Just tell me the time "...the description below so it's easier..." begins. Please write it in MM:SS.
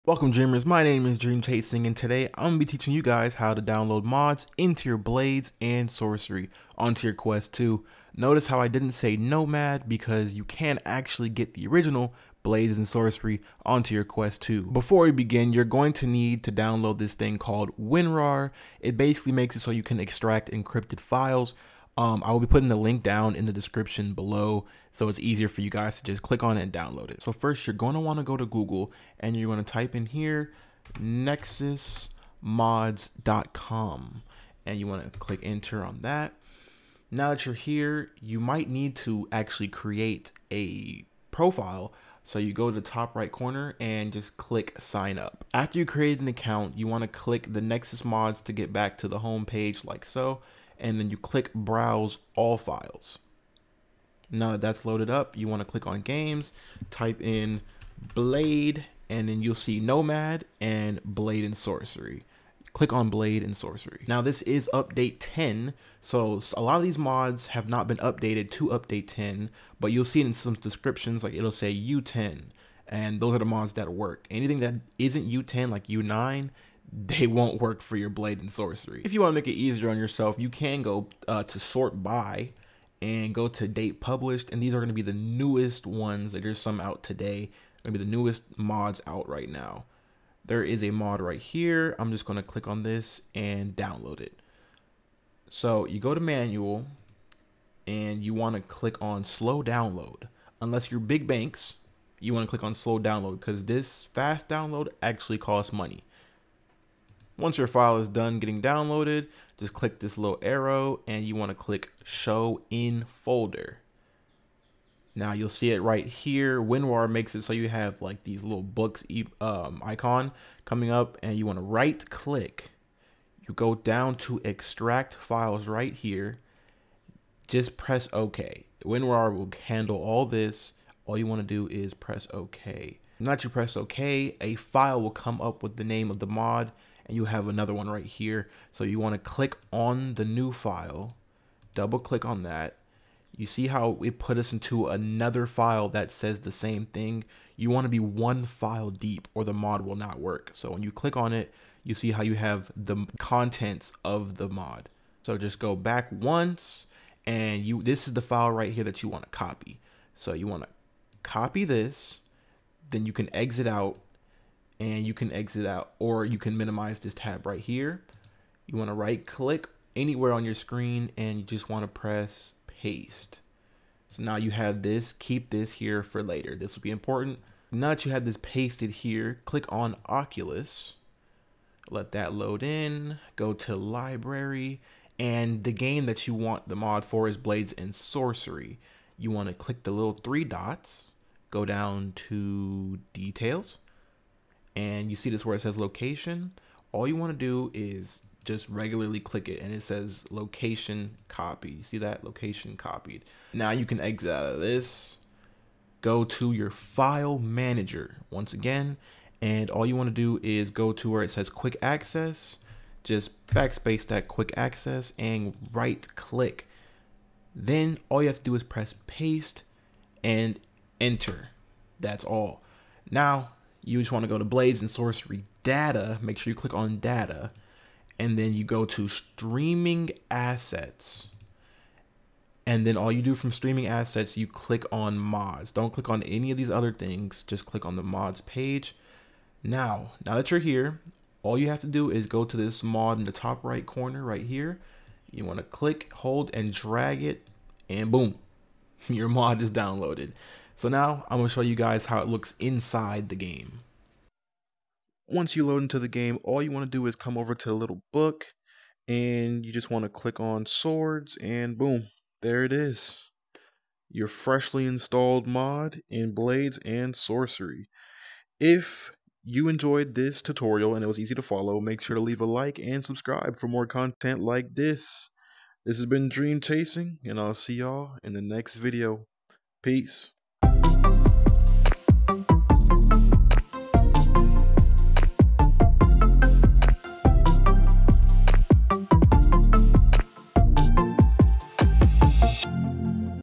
00:23.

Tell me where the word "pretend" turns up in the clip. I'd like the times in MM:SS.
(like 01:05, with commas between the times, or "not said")
not said.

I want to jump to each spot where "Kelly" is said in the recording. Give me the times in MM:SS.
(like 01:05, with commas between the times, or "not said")
not said.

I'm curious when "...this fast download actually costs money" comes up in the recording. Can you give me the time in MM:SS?
01:43.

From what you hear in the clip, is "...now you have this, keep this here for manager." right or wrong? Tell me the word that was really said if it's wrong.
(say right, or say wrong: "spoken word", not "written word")
wrong: "later", not "manager".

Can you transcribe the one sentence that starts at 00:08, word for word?
Notice how I didn't say Nomad because you can actually get the original Blades and Sorcery onto your Quest 2.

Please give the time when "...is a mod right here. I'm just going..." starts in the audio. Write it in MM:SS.
01:30.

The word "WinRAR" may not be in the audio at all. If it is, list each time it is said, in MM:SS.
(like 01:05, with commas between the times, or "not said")
00:17, 01:56, 02:08.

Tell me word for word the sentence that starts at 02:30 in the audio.
So when you click on it, you see how you have the contents of the mod.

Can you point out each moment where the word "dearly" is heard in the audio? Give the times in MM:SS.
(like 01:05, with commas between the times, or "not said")
not said.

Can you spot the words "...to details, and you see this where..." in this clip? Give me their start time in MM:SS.
03:12.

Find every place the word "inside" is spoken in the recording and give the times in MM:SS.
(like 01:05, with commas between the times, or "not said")
04:12.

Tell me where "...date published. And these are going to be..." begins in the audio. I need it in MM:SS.
01:23.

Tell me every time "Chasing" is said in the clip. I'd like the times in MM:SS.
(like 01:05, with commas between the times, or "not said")
00:01, 04:36.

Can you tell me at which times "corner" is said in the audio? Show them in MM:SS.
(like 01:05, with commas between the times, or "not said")
00:43, 04:03.